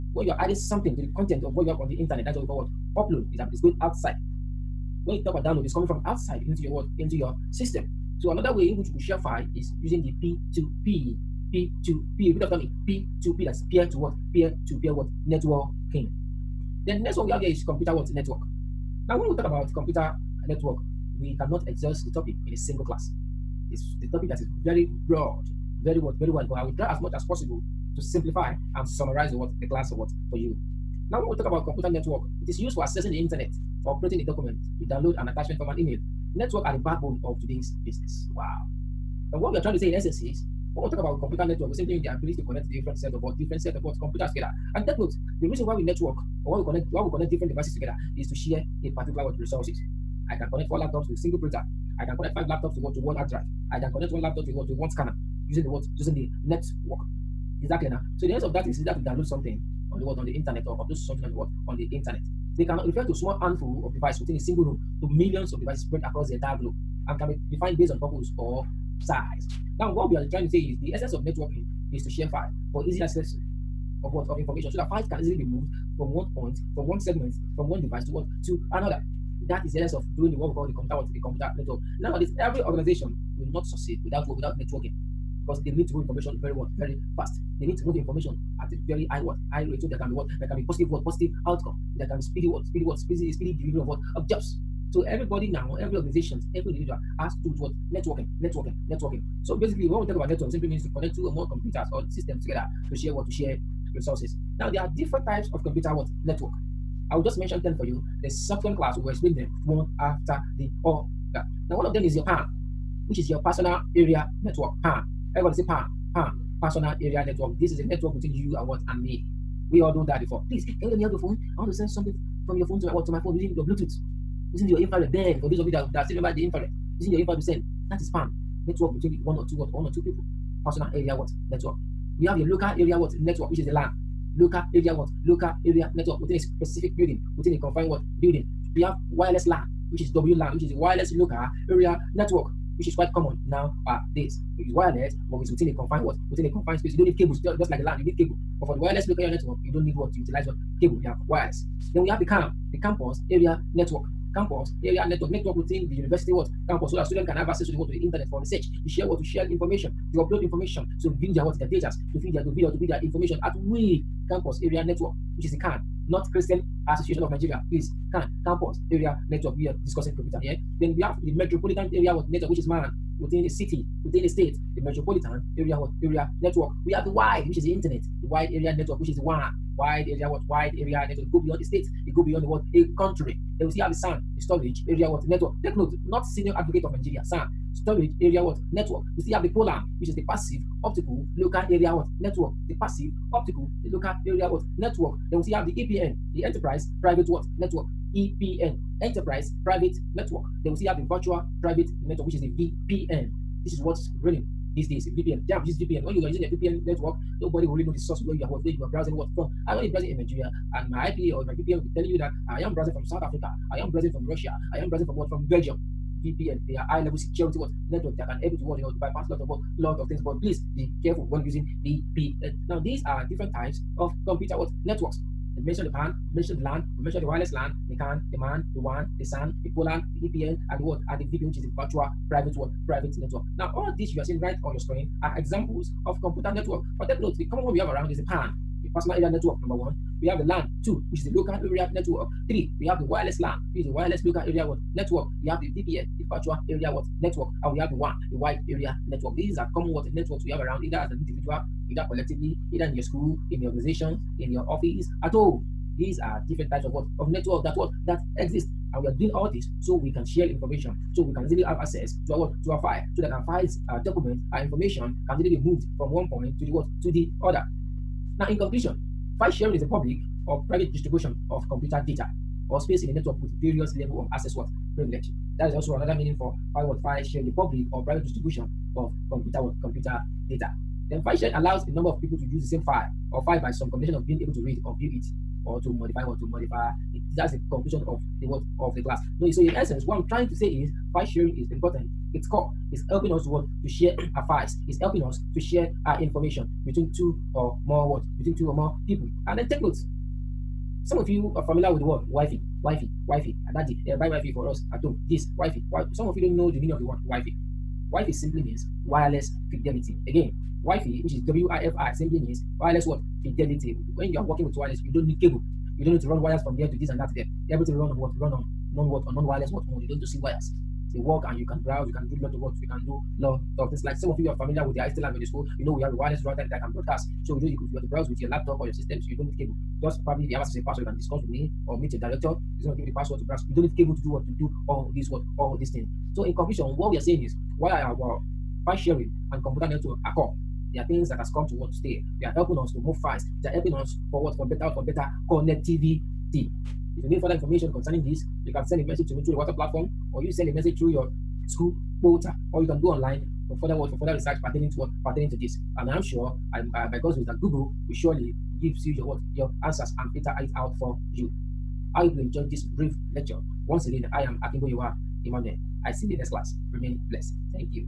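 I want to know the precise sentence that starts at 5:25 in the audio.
You know we have a wireless router that can broadcast.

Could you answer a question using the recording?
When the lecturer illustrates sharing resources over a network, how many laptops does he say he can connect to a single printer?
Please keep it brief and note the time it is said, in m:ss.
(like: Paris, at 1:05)
4, at 0:50.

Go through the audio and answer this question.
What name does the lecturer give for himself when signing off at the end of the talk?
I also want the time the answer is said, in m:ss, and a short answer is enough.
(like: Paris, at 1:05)
Akimbo Yowa Emmanuel, at 6:04.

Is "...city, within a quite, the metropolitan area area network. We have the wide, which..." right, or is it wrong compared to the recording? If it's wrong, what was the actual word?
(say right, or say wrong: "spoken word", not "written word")
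wrong: "state", not "quite".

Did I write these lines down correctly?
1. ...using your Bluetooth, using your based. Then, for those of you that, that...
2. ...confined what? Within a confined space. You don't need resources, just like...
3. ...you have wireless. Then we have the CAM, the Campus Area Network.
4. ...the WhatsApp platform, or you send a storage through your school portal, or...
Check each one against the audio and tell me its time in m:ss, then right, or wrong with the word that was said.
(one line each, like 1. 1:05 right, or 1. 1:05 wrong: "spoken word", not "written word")
1. 2:03 wrong: "infrared", not "based"
2. 2:25 wrong: "cables", not "resources"
3. 2:31 right
4. 5:49 wrong: "message", not "storage".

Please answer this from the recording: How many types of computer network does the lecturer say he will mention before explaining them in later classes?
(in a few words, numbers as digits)
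10.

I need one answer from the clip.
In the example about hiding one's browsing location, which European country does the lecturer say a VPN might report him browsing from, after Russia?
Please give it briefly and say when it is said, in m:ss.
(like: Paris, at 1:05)
Belgium, at 3:35.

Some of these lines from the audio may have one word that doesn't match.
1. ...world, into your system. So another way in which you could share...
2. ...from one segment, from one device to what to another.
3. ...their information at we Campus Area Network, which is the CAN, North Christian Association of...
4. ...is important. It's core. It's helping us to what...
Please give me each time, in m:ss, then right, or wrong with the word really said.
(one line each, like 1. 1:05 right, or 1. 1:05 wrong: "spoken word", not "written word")
1. 0:06 right
2. 1:16 right
3. 2:42 right
4. 4:51 right.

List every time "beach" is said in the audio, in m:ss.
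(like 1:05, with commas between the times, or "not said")
not said.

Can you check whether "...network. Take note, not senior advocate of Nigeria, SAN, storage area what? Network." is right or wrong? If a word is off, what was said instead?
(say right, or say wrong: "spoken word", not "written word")
right.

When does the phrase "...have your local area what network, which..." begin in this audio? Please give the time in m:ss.
2:12.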